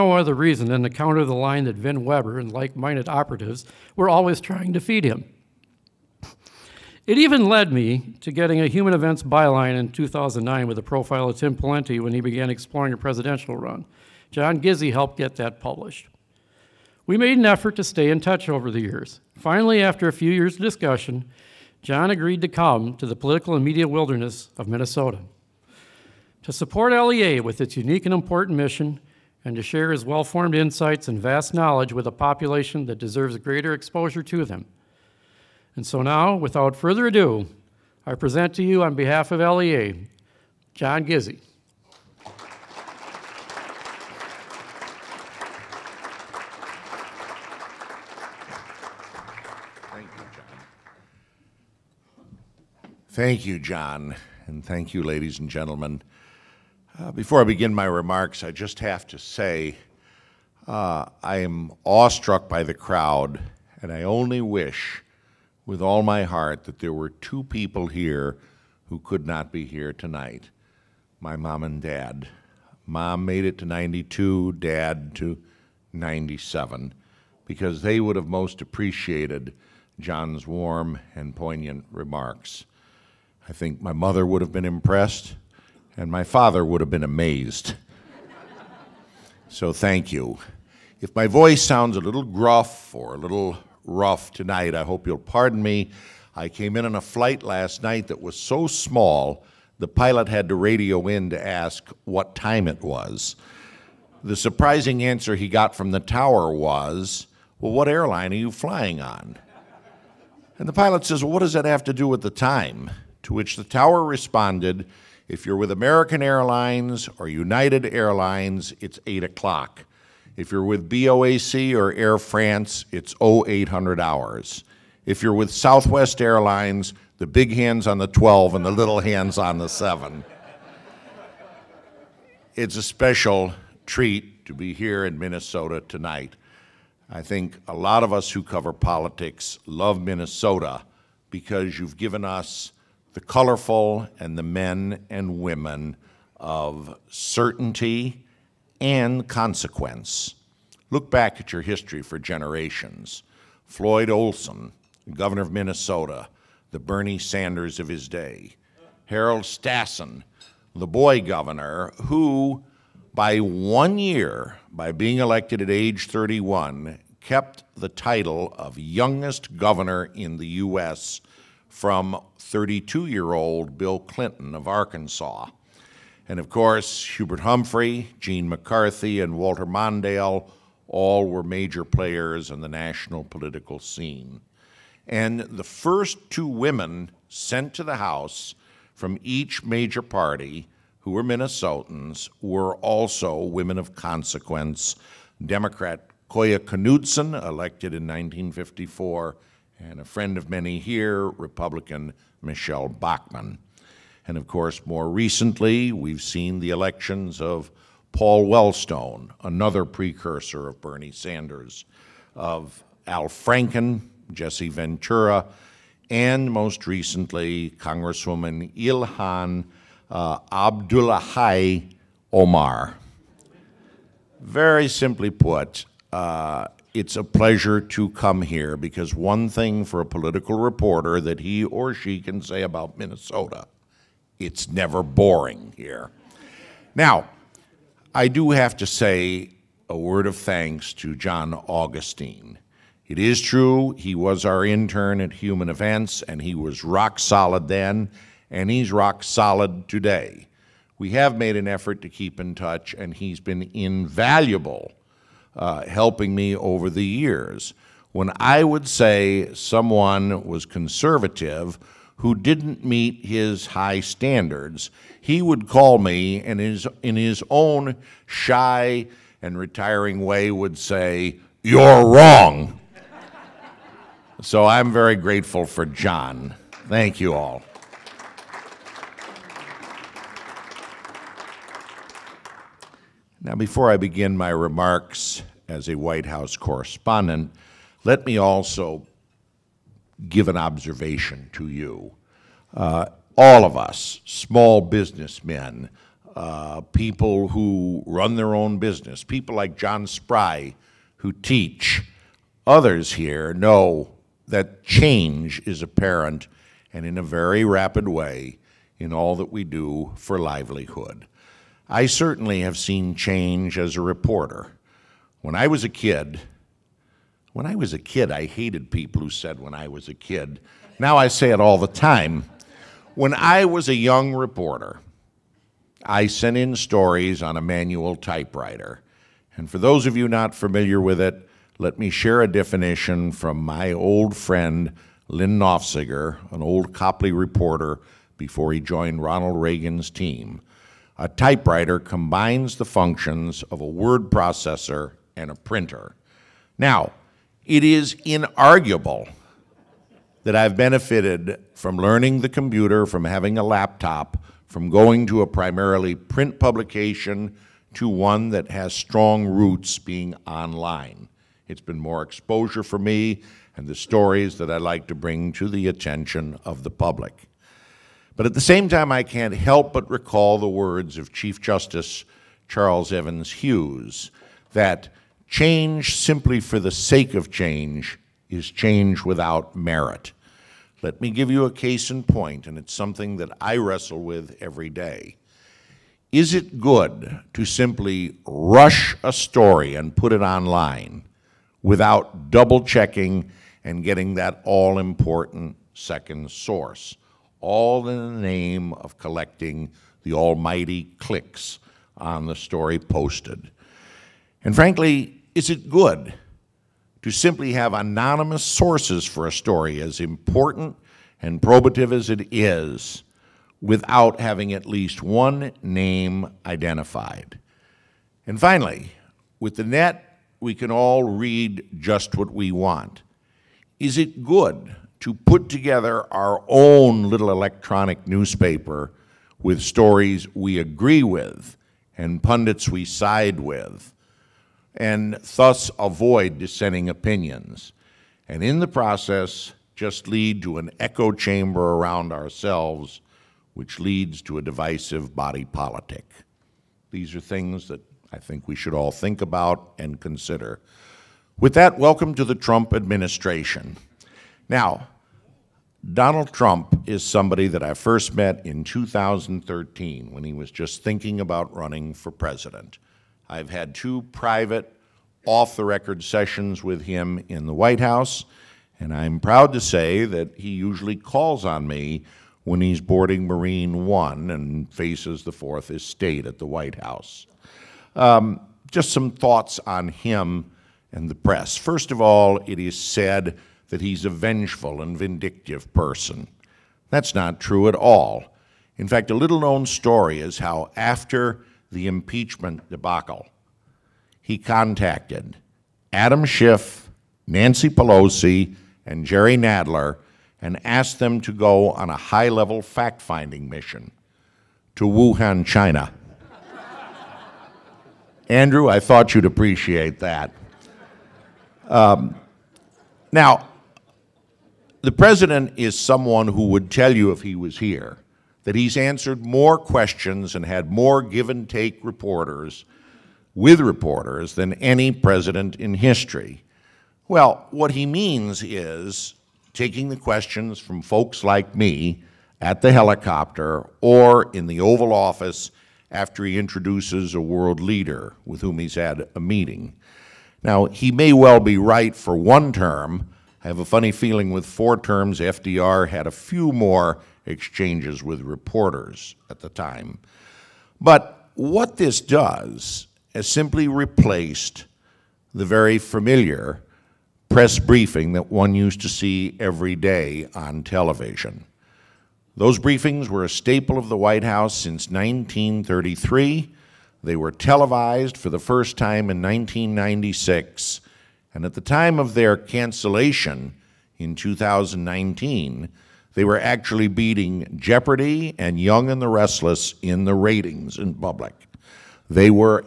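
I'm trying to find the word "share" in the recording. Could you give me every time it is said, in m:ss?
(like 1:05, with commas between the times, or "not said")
0:29, 5:32.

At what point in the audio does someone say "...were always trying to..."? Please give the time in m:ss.
0:03.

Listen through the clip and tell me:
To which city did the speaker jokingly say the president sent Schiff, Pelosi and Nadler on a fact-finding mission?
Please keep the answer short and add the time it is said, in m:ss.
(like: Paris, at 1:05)
Wuhan, at 8:25.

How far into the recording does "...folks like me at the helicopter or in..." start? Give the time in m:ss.
8:51.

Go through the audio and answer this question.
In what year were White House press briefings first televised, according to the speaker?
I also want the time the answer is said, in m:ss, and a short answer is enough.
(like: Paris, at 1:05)
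1996, at 9:29.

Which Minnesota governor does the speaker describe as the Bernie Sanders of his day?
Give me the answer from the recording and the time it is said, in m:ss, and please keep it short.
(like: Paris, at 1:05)
Floyd Olson, at 2:33.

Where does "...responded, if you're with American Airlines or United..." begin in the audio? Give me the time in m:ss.
1:54.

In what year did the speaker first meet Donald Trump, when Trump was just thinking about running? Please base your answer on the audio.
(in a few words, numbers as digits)
2013.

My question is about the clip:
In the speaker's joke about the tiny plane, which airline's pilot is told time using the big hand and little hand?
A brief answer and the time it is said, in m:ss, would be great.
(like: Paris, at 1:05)
Southwest Airlines, at 2:05.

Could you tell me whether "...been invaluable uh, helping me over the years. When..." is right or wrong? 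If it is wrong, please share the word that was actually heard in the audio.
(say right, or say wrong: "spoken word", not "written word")
right.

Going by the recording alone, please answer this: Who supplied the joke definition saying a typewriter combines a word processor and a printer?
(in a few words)
Lyn Nofziger.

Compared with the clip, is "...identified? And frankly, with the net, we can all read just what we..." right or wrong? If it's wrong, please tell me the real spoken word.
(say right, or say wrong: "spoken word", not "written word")
wrong: "finally", not "frankly".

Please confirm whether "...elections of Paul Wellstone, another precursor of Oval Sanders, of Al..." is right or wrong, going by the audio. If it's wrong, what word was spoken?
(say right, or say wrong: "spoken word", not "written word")
wrong: "Bernie", not "Oval".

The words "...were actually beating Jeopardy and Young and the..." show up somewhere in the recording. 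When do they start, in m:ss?
9:36.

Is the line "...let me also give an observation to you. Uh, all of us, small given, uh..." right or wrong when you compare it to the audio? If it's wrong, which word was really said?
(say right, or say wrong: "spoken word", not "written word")
wrong: "businessmen", not "given".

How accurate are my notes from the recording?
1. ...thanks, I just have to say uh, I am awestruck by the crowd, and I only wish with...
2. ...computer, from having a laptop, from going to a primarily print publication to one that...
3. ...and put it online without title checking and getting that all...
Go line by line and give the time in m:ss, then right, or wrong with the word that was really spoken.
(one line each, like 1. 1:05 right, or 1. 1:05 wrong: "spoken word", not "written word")
1. 0:57 wrong: "remarks", not "thanks"
2. 5:52 right
3. 6:29 wrong: "double", not "title".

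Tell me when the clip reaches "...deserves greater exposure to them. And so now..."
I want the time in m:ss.
0:32.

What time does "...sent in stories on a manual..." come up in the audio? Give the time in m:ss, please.
5:26.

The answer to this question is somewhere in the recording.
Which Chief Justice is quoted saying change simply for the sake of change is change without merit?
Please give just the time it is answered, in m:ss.
6:12.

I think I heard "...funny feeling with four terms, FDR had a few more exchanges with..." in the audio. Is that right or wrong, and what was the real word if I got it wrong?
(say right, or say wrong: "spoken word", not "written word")
right.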